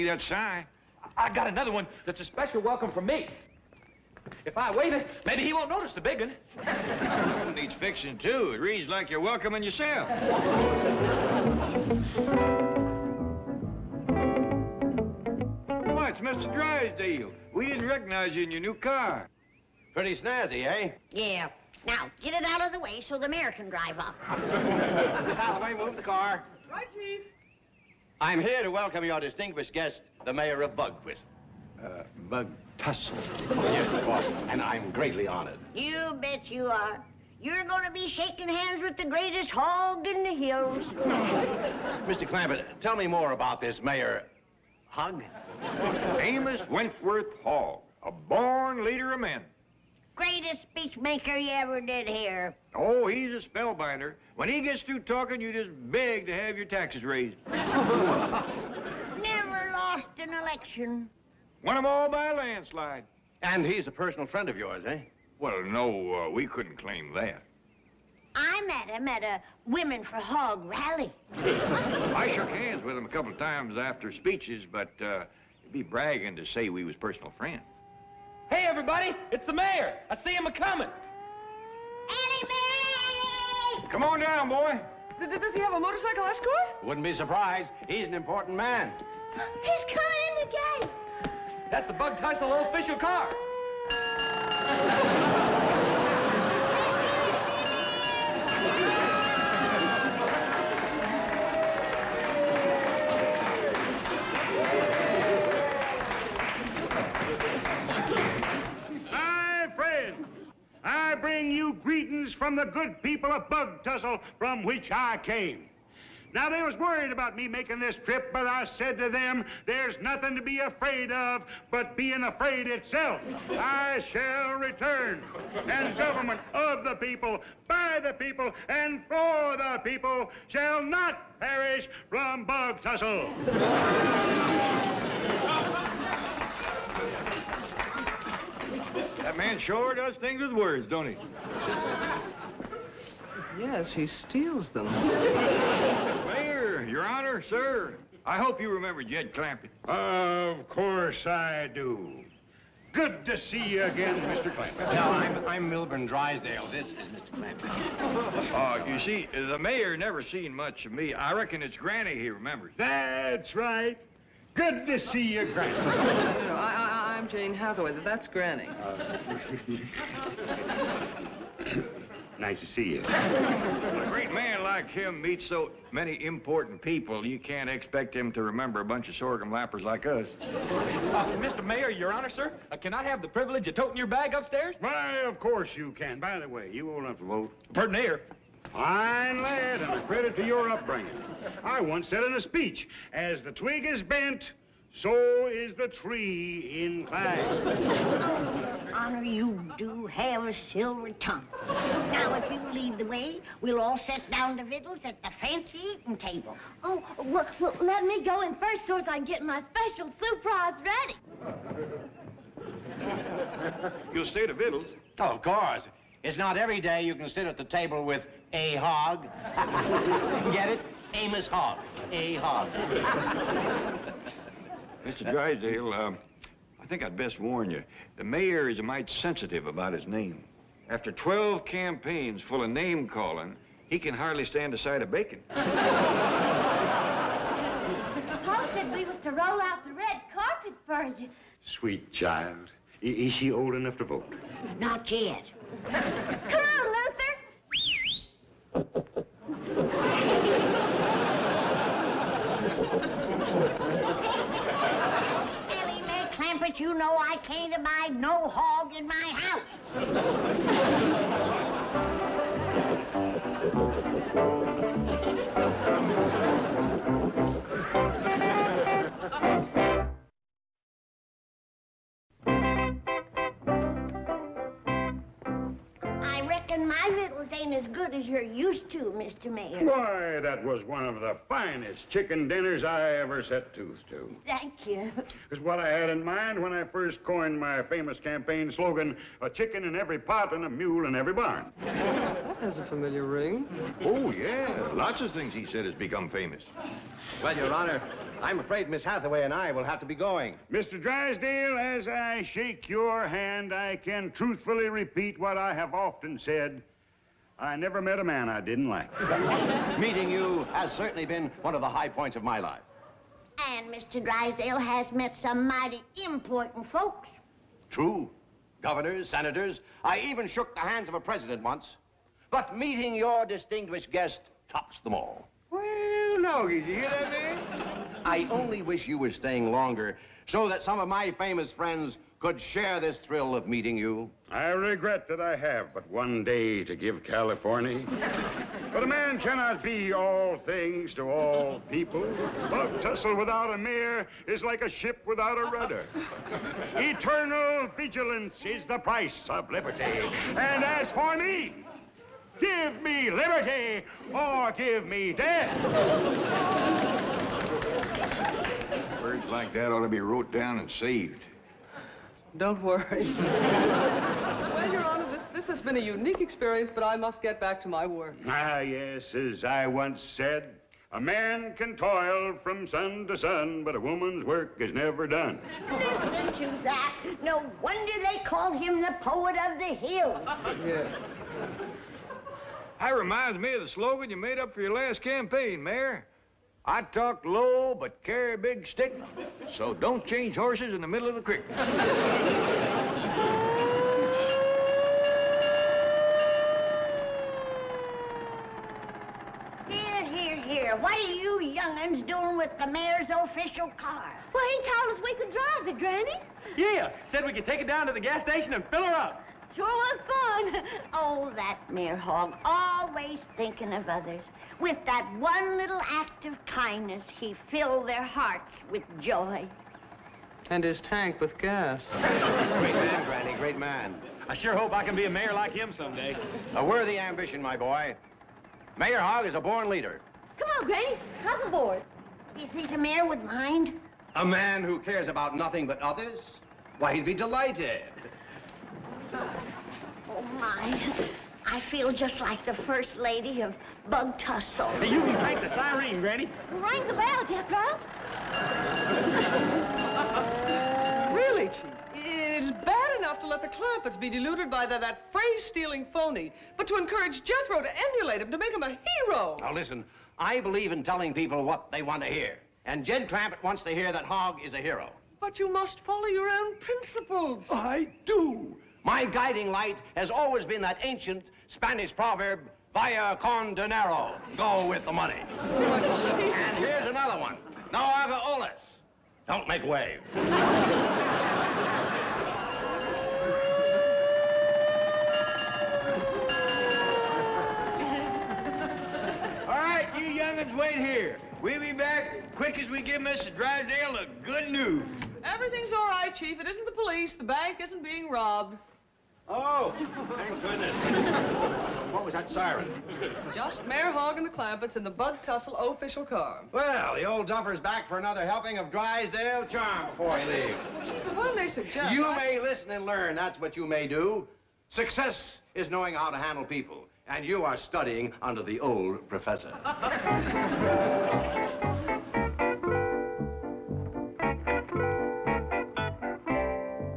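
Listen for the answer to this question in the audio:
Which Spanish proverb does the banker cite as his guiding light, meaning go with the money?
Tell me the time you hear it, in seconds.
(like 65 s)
472 s.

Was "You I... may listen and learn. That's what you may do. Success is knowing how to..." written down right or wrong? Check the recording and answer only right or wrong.
right.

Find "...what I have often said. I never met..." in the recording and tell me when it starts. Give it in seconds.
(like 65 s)
305 s.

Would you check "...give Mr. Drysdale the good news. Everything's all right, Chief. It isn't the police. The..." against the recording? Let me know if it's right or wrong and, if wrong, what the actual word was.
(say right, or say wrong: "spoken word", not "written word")
right.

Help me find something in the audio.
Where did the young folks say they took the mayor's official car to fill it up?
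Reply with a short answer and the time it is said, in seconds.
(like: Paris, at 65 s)
The gas station, at 408 s.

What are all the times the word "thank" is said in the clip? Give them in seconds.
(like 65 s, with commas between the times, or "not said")
284 s, 500 s.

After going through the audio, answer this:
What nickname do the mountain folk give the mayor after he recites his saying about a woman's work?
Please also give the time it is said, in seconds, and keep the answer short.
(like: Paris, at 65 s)
The poet of the hills, at 378 s.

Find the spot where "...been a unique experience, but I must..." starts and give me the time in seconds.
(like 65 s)
365 s.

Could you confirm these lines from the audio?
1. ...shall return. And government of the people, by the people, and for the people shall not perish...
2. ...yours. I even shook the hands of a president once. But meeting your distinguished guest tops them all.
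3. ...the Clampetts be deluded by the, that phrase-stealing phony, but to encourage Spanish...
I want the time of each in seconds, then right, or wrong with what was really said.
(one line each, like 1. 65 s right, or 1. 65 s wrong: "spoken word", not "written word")
1. 124 s right
2. 319 s wrong: "senators", not "yours"
3. 453 s wrong: "Jethro", not "Spanish".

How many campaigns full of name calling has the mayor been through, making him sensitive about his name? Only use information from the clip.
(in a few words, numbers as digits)
12.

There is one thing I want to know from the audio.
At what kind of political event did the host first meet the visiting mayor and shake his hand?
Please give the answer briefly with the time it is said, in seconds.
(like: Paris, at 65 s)
A Women for Hogg rally, at 69 s.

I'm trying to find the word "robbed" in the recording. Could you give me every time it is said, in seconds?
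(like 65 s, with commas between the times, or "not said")
498 s.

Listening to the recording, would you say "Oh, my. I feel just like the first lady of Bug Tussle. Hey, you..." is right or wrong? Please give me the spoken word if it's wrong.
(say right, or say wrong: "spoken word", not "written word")
right.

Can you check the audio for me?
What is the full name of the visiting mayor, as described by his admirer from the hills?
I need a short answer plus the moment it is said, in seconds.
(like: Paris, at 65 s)
Amos Wentworth Hogg, at 46 s.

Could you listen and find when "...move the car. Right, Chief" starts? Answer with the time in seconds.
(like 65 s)
25 s.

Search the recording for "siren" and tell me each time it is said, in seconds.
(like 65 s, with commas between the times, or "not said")
445 s, 502 s.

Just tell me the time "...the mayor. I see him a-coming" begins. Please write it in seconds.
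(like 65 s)
79 s.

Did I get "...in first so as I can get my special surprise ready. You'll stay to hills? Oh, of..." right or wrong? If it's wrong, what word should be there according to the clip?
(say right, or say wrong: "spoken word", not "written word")
wrong: "victuals", not "hills".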